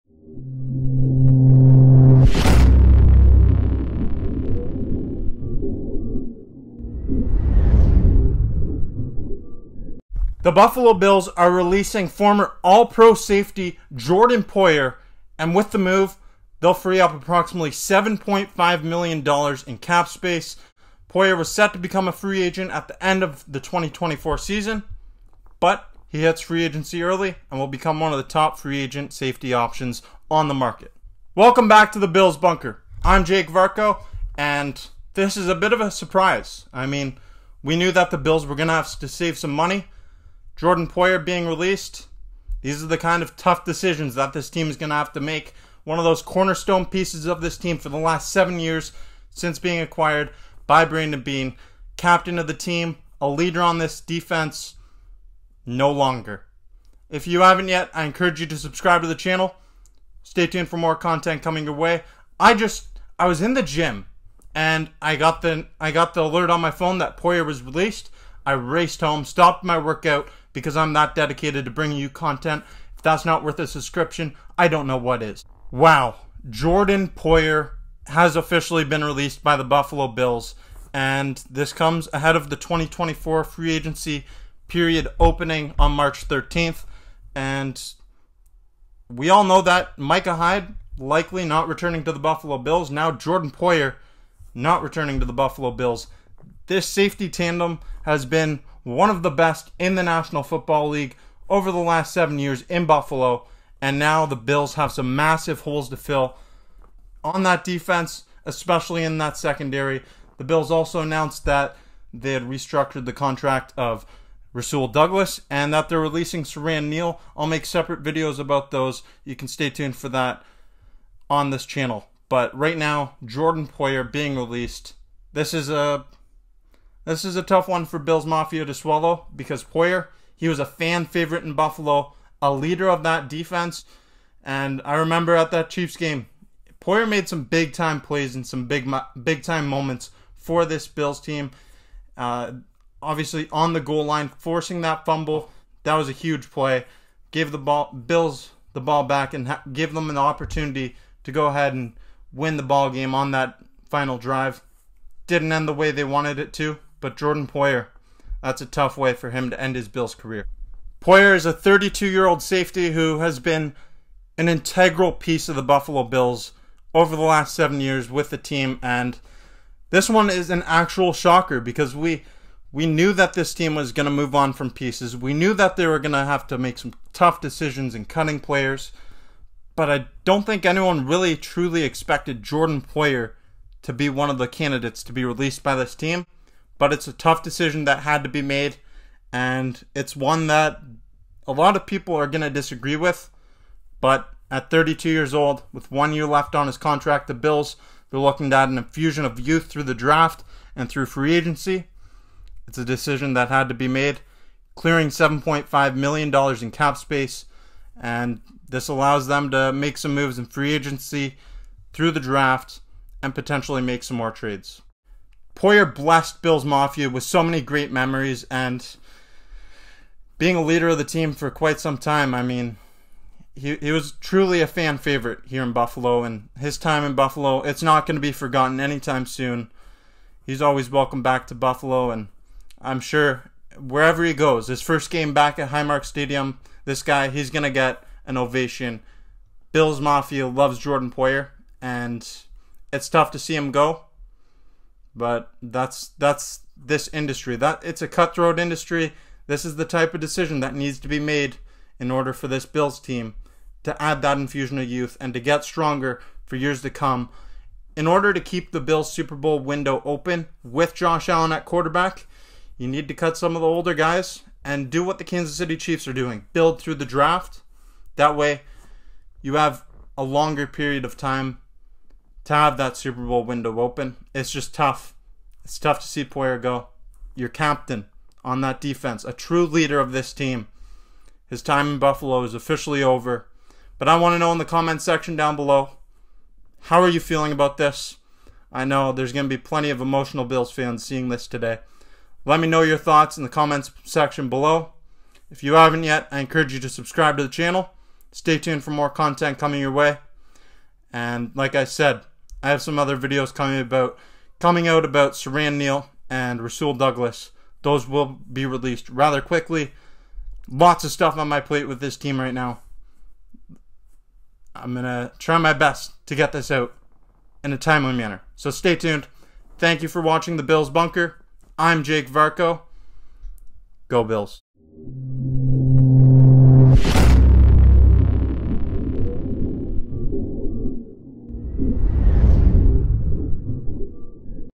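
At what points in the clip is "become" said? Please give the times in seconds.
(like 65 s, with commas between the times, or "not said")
21 s, 27 s.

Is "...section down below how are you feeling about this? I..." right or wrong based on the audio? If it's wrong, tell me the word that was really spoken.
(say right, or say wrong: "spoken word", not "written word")
right.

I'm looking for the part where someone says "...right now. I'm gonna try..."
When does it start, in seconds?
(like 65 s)
312 s.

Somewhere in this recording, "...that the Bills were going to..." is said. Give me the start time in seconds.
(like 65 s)
37 s.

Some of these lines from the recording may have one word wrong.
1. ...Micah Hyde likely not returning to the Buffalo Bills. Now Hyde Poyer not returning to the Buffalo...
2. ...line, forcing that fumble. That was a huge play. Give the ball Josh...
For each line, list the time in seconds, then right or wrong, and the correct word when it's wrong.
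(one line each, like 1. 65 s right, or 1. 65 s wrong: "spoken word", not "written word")
1. 89 s wrong: "Jordan", not "Hyde"
2. 144 s wrong: "Bills", not "Josh".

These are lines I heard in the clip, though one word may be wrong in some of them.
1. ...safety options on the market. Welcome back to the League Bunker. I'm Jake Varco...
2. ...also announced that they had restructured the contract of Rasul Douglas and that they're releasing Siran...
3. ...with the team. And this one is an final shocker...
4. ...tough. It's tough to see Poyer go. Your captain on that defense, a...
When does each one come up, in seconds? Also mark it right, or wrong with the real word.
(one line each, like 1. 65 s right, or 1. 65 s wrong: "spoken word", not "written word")
1. 29 s wrong: "Bills", not "League"
2. 110 s right
3. 168 s wrong: "actual", not "final"
4. 274 s right.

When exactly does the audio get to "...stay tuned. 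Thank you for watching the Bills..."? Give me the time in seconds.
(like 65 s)
318 s.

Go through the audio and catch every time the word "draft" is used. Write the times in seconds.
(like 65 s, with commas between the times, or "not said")
199 s, 212 s, 267 s.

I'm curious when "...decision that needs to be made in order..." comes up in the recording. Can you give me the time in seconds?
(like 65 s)
250 s.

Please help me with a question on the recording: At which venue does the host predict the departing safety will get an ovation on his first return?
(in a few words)
Highmark Stadium.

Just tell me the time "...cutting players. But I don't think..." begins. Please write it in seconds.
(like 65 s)
178 s.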